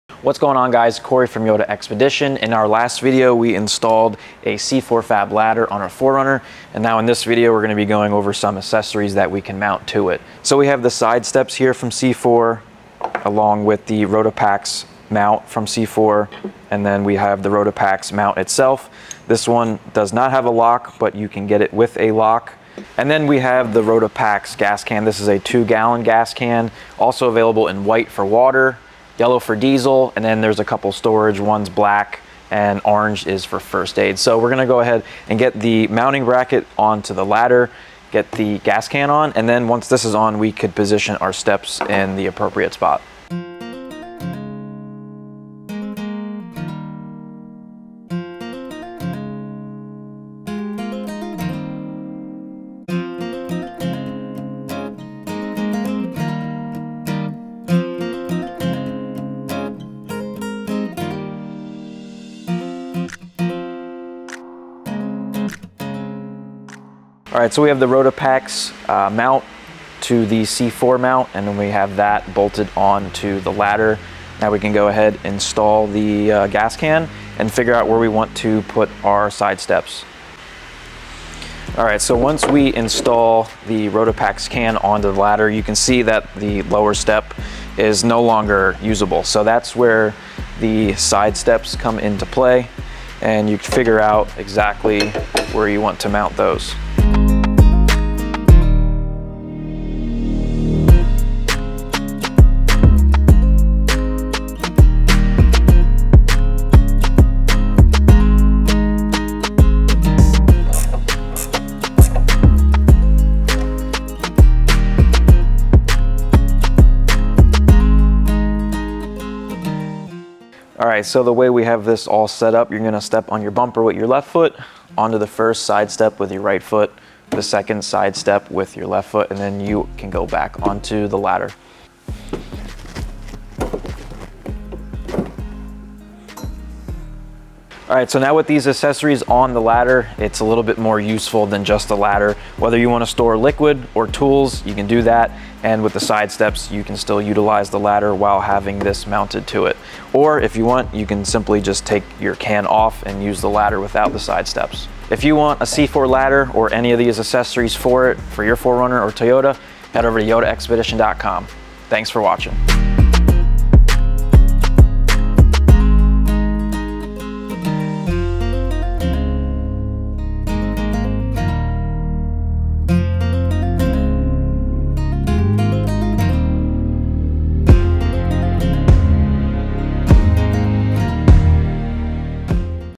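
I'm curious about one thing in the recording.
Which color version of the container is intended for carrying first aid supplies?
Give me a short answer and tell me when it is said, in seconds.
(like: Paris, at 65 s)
Orange, at 32 s.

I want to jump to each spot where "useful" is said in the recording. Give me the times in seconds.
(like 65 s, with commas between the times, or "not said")
141 s.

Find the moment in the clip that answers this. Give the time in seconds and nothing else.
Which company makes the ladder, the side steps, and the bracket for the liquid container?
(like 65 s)
4 s.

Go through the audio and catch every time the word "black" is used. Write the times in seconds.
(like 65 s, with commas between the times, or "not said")
31 s.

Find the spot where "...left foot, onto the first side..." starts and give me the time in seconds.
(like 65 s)
124 s.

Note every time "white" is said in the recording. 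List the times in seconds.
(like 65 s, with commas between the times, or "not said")
27 s.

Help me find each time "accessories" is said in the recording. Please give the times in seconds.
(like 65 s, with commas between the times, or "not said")
8 s, 138 s, 157 s.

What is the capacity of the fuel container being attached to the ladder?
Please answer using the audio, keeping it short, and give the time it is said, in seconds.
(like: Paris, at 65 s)
2 gallons, at 25 s.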